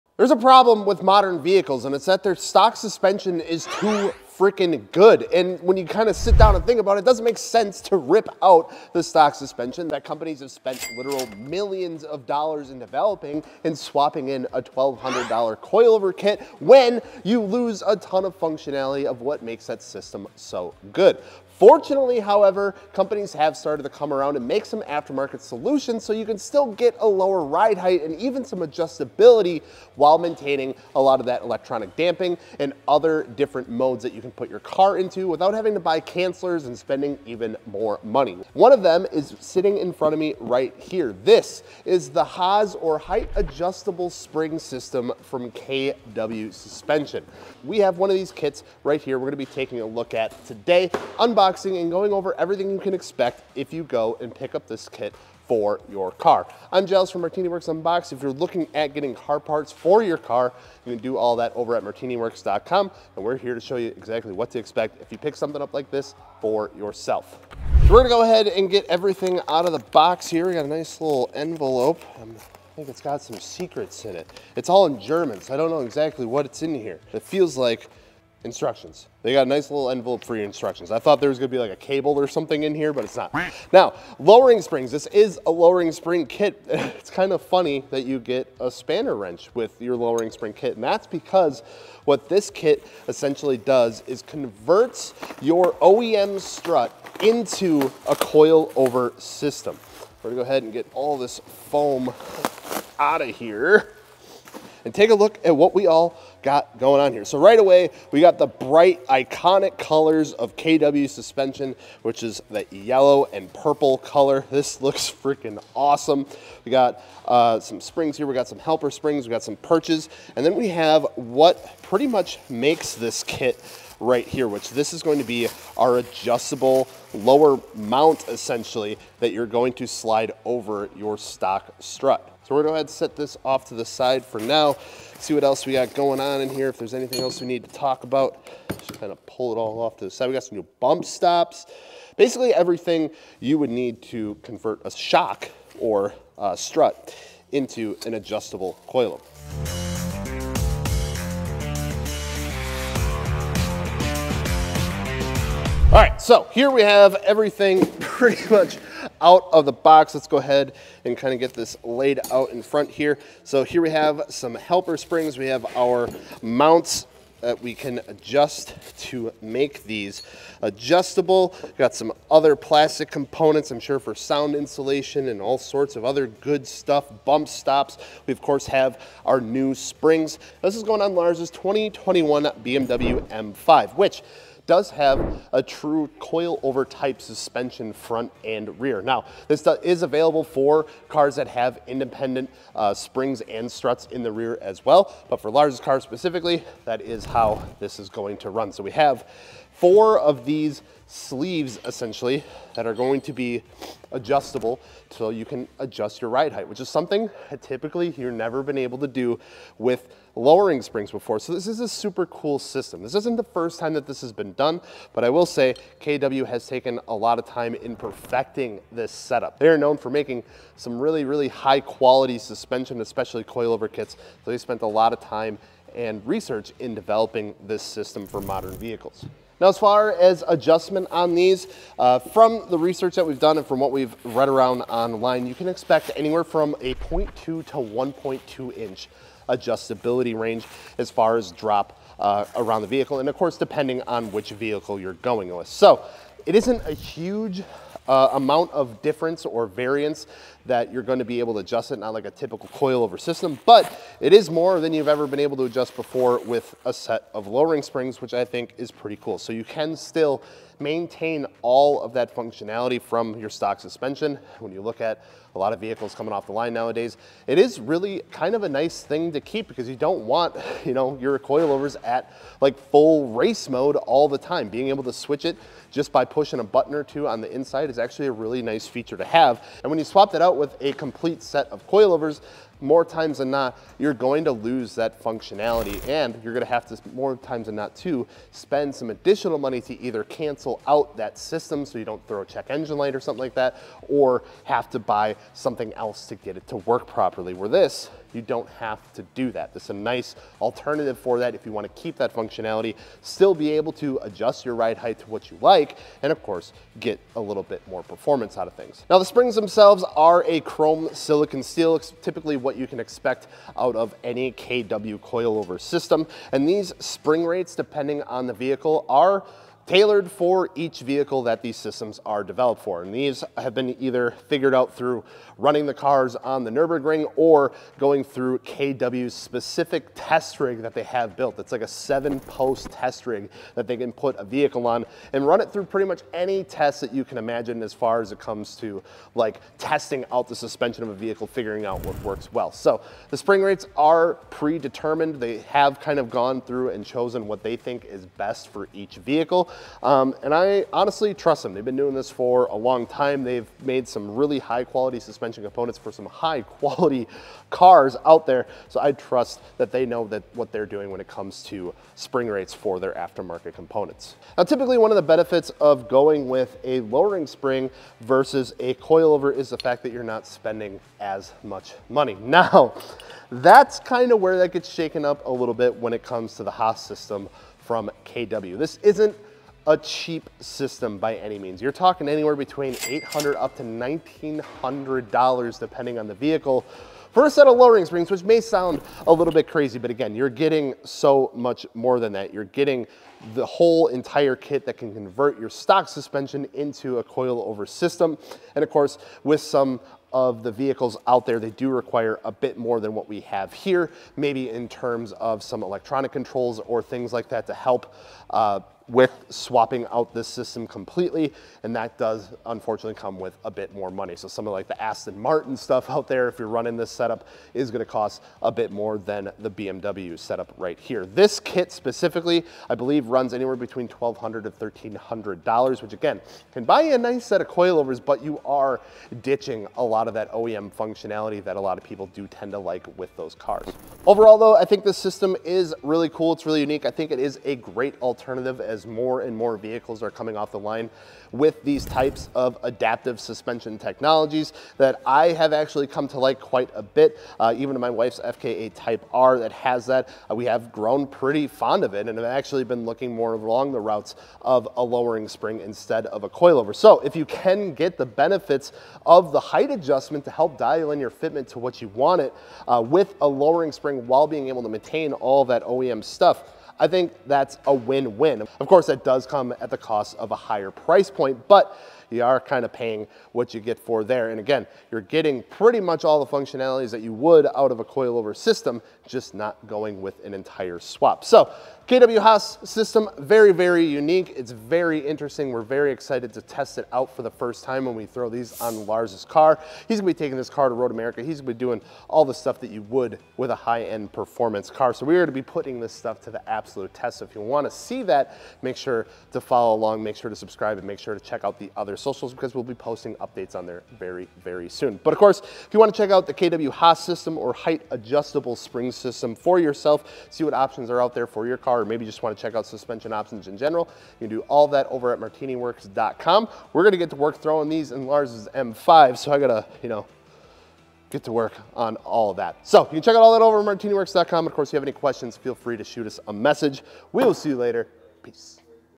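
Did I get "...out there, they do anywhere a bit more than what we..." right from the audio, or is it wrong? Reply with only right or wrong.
wrong.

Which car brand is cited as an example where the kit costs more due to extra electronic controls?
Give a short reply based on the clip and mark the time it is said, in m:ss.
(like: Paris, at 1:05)
Aston Martin, at 6:55.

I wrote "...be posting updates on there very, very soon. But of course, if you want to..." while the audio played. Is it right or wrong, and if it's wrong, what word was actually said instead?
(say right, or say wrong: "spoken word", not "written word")
right.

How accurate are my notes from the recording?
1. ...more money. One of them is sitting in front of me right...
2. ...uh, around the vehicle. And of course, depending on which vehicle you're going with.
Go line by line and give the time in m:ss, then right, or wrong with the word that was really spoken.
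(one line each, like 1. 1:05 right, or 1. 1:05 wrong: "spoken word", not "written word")
1. 0:37 right
2. 4:02 right.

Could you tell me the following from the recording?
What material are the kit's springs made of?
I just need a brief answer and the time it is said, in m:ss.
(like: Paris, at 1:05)
chrome silicon steel, at 5:10.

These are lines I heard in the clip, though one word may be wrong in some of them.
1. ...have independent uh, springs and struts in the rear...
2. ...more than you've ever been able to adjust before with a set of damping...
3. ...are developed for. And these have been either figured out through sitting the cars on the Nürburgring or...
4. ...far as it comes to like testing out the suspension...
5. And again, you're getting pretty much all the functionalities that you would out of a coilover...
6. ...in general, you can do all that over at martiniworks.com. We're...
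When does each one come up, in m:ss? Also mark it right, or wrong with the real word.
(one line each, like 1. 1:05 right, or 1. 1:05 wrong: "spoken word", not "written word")
1. 3:11 right
2. 4:14 wrong: "lowering", not "damping"
3. 5:22 wrong: "running", not "sitting"
4. 5:37 right
5. 7:54 right
6. 8:33 right.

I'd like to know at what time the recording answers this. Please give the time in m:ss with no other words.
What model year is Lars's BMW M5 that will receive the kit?
3:01.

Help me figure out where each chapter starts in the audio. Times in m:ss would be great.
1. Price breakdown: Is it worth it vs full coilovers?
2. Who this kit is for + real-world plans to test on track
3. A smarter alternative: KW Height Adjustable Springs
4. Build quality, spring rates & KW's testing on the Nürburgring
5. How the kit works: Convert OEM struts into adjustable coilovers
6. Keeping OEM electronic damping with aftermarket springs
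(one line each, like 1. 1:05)
1. 6:05
2. 7:16
3. 0:41
4. 5:10
5. 2:01
6. 4:22.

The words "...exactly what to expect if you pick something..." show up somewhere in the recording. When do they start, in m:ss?
1:03.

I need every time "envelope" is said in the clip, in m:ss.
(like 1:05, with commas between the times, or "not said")
1:11, 1:19.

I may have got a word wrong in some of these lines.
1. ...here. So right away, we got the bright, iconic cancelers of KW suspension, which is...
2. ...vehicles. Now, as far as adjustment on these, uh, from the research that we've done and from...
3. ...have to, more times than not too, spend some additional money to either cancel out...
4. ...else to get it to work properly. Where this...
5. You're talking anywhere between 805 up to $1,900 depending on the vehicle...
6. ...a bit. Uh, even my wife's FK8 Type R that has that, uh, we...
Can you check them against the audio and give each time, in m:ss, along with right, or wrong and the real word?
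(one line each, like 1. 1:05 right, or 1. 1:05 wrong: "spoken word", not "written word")
1. 1:47 wrong: "colors", not "cancelers"
2. 3:48 right
3. 4:46 right
4. 4:55 right
5. 6:21 wrong: "800", not "805"
6. 7:26 right.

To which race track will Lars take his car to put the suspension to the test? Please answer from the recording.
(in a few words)
Road America.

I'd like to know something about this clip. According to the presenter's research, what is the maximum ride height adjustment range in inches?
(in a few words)
1.2 inches.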